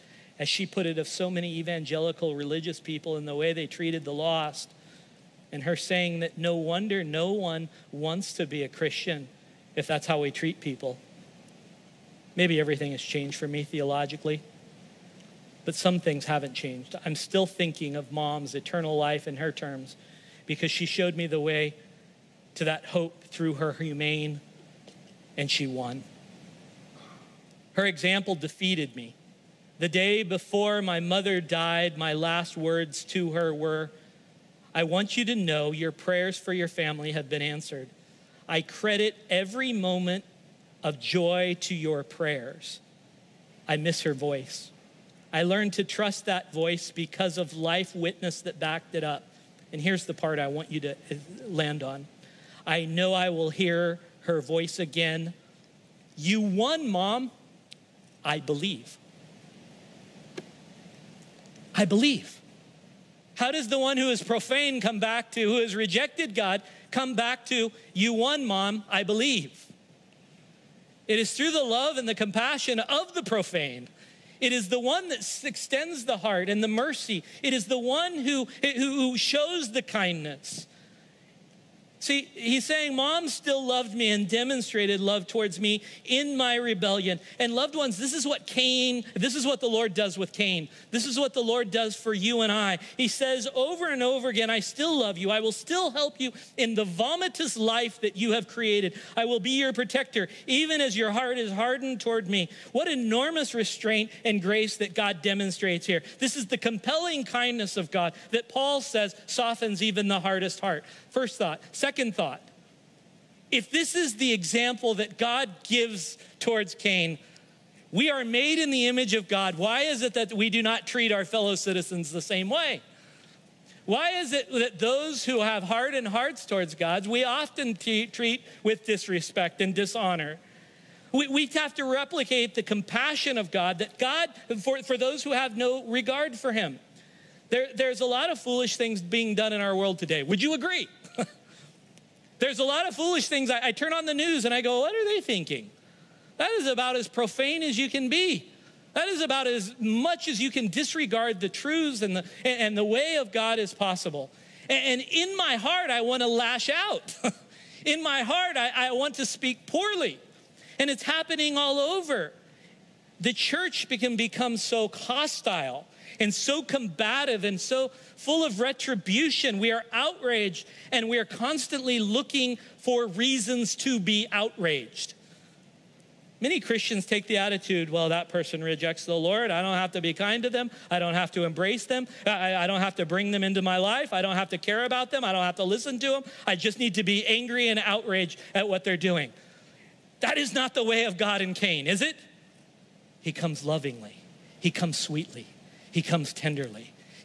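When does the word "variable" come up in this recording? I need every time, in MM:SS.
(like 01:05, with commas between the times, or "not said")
not said.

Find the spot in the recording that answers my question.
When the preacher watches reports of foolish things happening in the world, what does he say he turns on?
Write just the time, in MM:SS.
02:24.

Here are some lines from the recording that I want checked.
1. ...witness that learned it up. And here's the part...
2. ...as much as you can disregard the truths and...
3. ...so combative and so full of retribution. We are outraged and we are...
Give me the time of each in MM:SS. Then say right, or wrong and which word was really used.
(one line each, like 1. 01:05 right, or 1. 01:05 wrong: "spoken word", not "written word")
1. 00:47 wrong: "backed", not "learned"
2. 02:29 right
3. 02:46 right.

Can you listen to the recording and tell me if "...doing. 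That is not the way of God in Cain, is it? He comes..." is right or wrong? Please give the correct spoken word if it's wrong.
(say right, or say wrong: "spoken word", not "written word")
right.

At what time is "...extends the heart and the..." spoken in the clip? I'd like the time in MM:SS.
01:15.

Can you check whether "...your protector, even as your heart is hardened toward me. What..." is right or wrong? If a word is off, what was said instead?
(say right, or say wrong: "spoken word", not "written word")
right.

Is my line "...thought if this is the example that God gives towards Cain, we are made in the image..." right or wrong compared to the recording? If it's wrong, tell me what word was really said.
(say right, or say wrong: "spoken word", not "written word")
right.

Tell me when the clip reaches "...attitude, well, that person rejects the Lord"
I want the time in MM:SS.
02:57.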